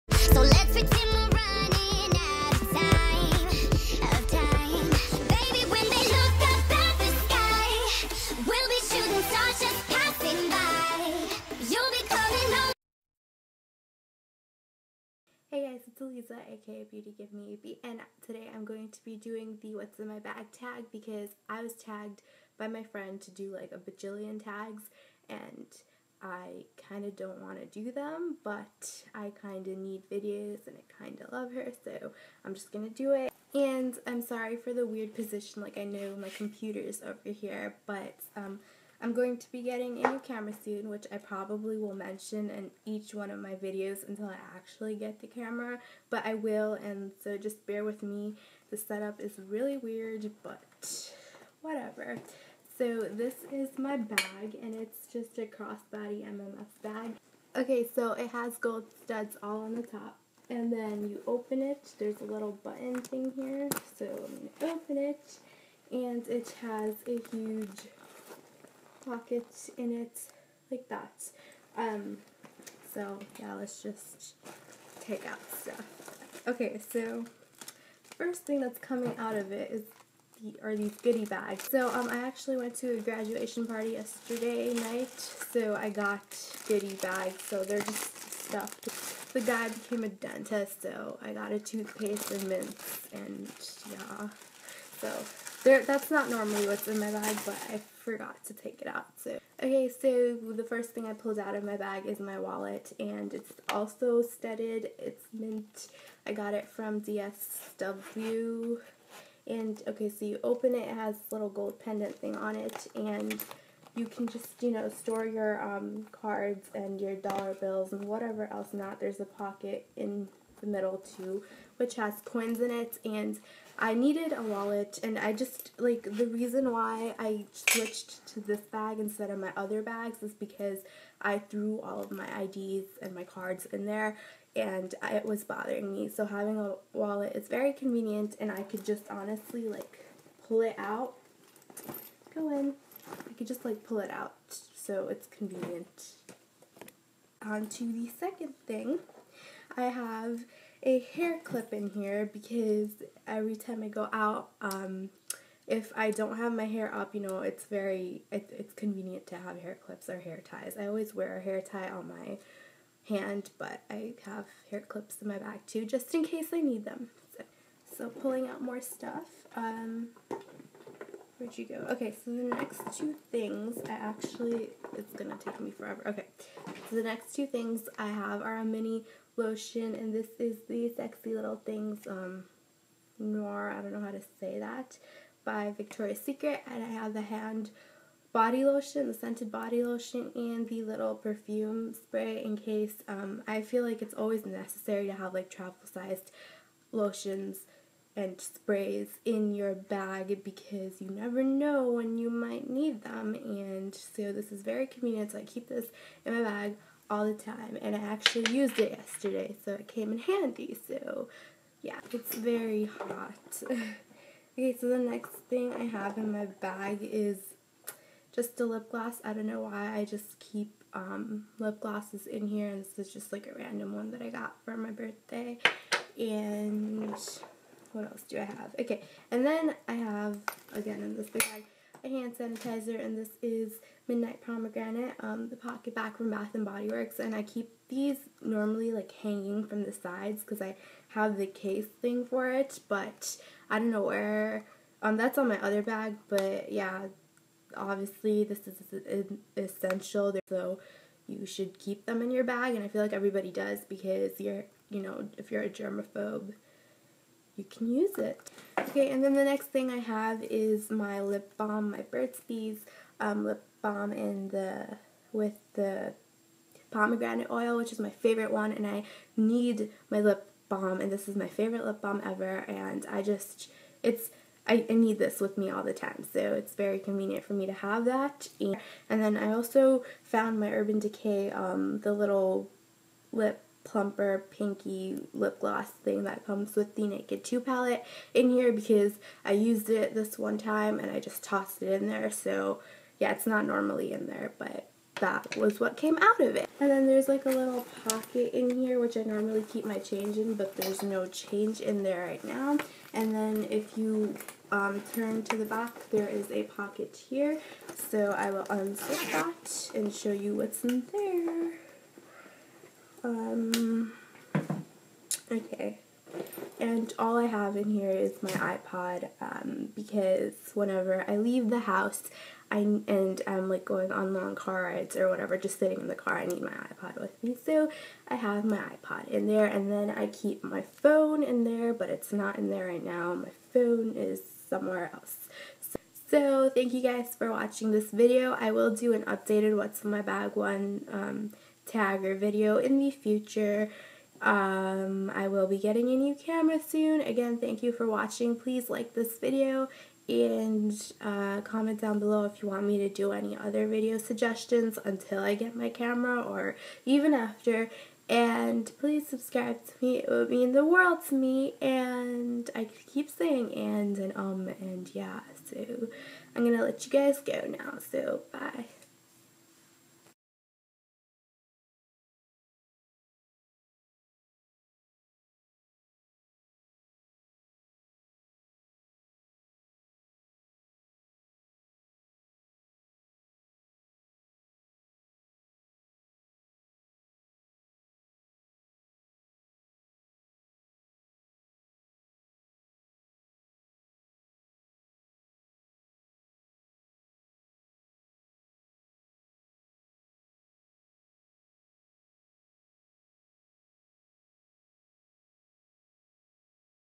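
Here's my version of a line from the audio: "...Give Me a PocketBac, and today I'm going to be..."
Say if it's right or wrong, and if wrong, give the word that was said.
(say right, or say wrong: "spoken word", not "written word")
wrong: "Beat", not "PocketBac".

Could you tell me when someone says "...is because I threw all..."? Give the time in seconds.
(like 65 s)
130 s.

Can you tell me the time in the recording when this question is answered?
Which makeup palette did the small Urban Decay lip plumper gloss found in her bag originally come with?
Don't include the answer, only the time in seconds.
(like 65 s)
287 s.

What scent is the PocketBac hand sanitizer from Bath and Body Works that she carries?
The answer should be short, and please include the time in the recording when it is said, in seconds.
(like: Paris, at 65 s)
Midnight Pomegranate, at 234 s.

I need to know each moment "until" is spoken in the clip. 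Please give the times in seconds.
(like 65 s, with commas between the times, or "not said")
44 s, 355 s.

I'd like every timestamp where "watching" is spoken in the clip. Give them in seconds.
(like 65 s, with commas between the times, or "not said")
337 s, 348 s.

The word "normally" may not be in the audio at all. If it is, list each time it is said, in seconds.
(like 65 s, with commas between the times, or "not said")
96 s, 238 s, 293 s, 299 s.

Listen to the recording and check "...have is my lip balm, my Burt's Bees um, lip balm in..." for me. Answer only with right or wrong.
right.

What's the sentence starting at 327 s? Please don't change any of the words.
So I have my iPod in there and then I keep my phone in there, but it's not in there right now.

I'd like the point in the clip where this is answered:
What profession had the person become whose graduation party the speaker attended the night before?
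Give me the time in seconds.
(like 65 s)
90 s.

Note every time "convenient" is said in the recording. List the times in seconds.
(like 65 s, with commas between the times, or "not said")
137 s, 145 s, 158 s, 204 s, 276 s.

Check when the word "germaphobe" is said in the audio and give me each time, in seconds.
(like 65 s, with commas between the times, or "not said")
255 s.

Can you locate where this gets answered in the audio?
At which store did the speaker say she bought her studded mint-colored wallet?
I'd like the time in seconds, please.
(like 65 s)
107 s.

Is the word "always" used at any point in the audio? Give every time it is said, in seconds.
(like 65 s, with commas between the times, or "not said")
160 s, 194 s.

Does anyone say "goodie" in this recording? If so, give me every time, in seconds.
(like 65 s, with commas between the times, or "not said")
81 s, 86 s.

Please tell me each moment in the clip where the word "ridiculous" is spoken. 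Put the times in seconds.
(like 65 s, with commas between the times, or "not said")
not said.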